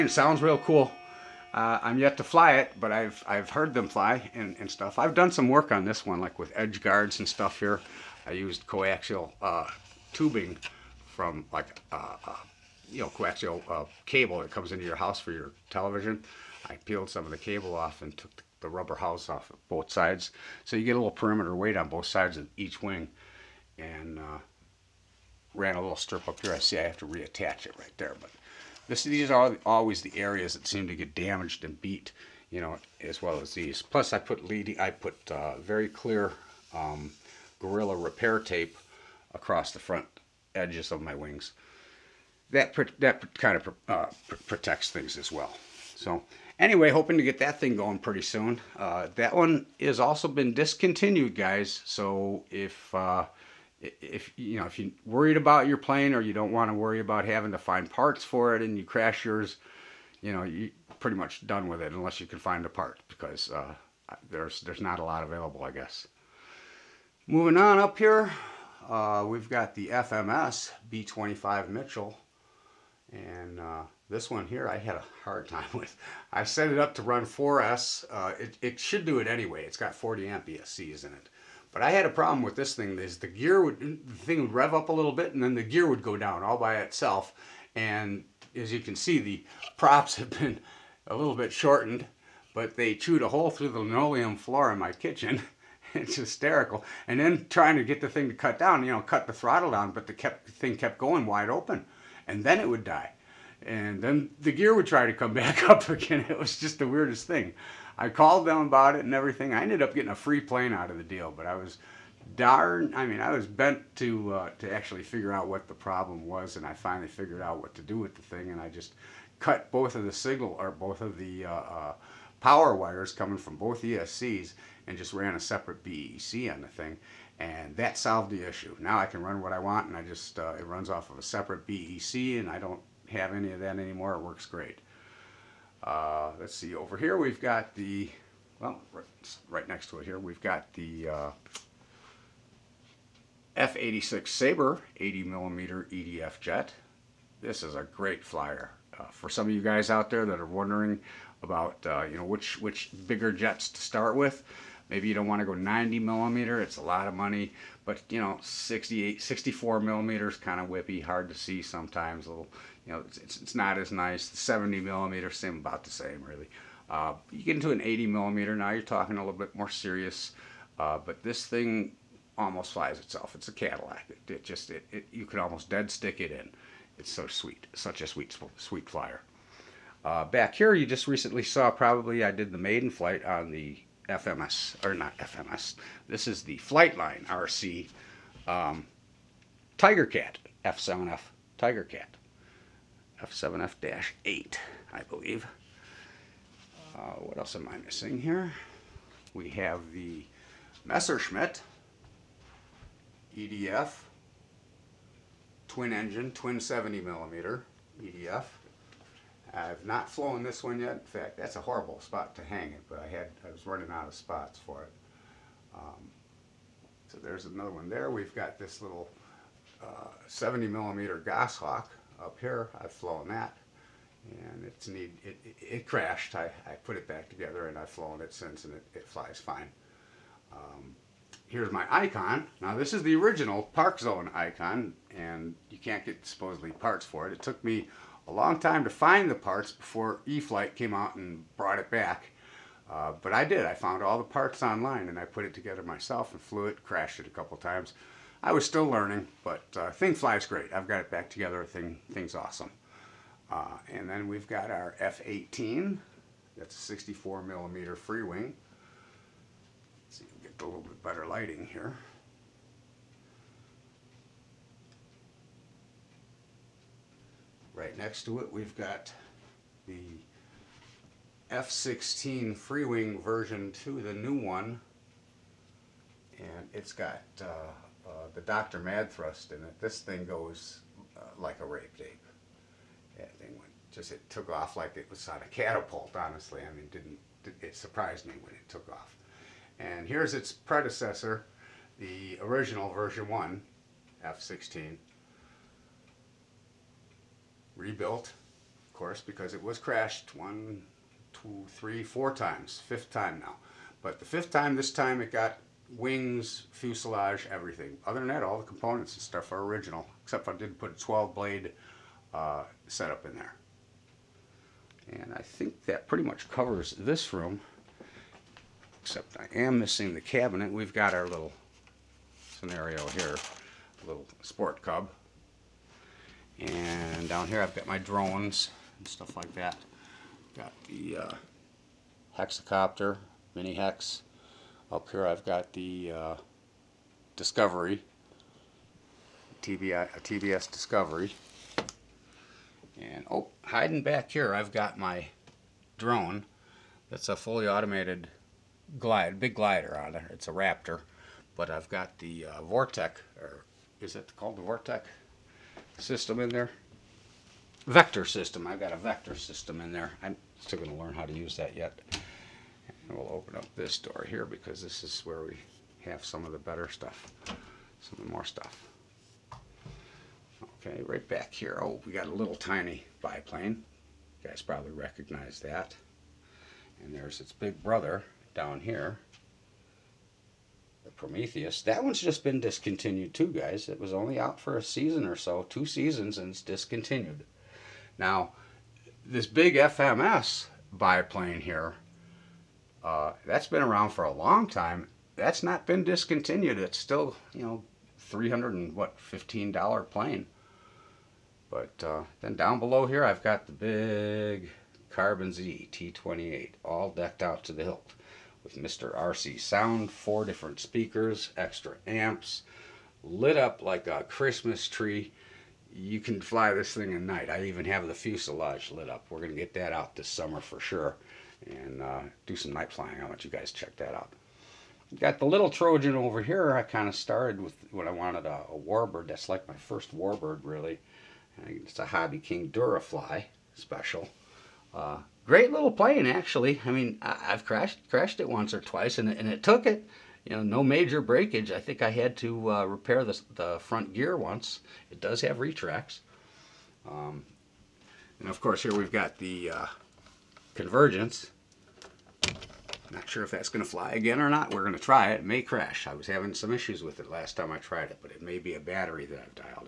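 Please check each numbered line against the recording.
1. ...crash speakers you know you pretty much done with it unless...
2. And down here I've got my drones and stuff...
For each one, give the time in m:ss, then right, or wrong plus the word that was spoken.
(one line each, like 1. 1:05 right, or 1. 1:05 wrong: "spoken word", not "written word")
1. 0:58 wrong: "yours", not "speakers"
2. 5:26 right.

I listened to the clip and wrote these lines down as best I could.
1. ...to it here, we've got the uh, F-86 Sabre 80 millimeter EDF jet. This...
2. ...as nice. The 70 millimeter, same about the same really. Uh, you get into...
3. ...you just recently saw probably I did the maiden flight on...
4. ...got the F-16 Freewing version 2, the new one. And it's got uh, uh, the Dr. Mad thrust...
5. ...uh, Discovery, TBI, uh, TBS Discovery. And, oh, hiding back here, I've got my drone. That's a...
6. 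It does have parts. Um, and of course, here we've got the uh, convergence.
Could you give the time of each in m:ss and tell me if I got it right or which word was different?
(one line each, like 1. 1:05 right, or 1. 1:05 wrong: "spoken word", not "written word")
1. 2:19 right
2. 2:43 right
3. 3:00 right
4. 4:28 right
5. 5:36 right
6. 7:25 wrong: "retracts", not "parts".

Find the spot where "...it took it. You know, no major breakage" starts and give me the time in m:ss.
7:19.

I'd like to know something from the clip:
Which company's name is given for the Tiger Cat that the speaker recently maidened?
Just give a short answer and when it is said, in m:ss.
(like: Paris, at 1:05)
Flightline RC, at 3:06.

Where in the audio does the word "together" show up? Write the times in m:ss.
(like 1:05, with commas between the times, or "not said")
3:47, 4:05, 4:11.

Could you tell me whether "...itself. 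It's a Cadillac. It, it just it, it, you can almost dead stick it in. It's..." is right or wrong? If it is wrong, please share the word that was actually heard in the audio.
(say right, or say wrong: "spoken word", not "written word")
right.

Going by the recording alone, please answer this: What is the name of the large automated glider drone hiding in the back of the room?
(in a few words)
Raptor.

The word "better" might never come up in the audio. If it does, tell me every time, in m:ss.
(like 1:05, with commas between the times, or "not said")
4:21, 6:06.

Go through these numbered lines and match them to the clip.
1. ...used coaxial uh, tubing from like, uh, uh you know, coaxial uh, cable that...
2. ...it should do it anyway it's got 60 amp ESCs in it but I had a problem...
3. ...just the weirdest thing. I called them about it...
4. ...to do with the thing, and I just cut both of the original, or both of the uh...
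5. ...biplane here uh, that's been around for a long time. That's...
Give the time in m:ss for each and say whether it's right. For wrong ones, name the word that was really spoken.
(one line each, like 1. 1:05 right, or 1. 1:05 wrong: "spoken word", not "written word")
1. 0:08 right
2. 1:18 wrong: "40", not "60"
3. 1:46 right
4. 1:57 wrong: "signal", not "original"
5. 6:30 right.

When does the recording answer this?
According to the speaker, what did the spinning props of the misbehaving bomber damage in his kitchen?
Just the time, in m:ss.
1:33.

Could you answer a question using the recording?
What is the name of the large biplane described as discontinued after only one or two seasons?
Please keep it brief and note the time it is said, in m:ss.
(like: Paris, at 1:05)
Prometheus, at 6:21.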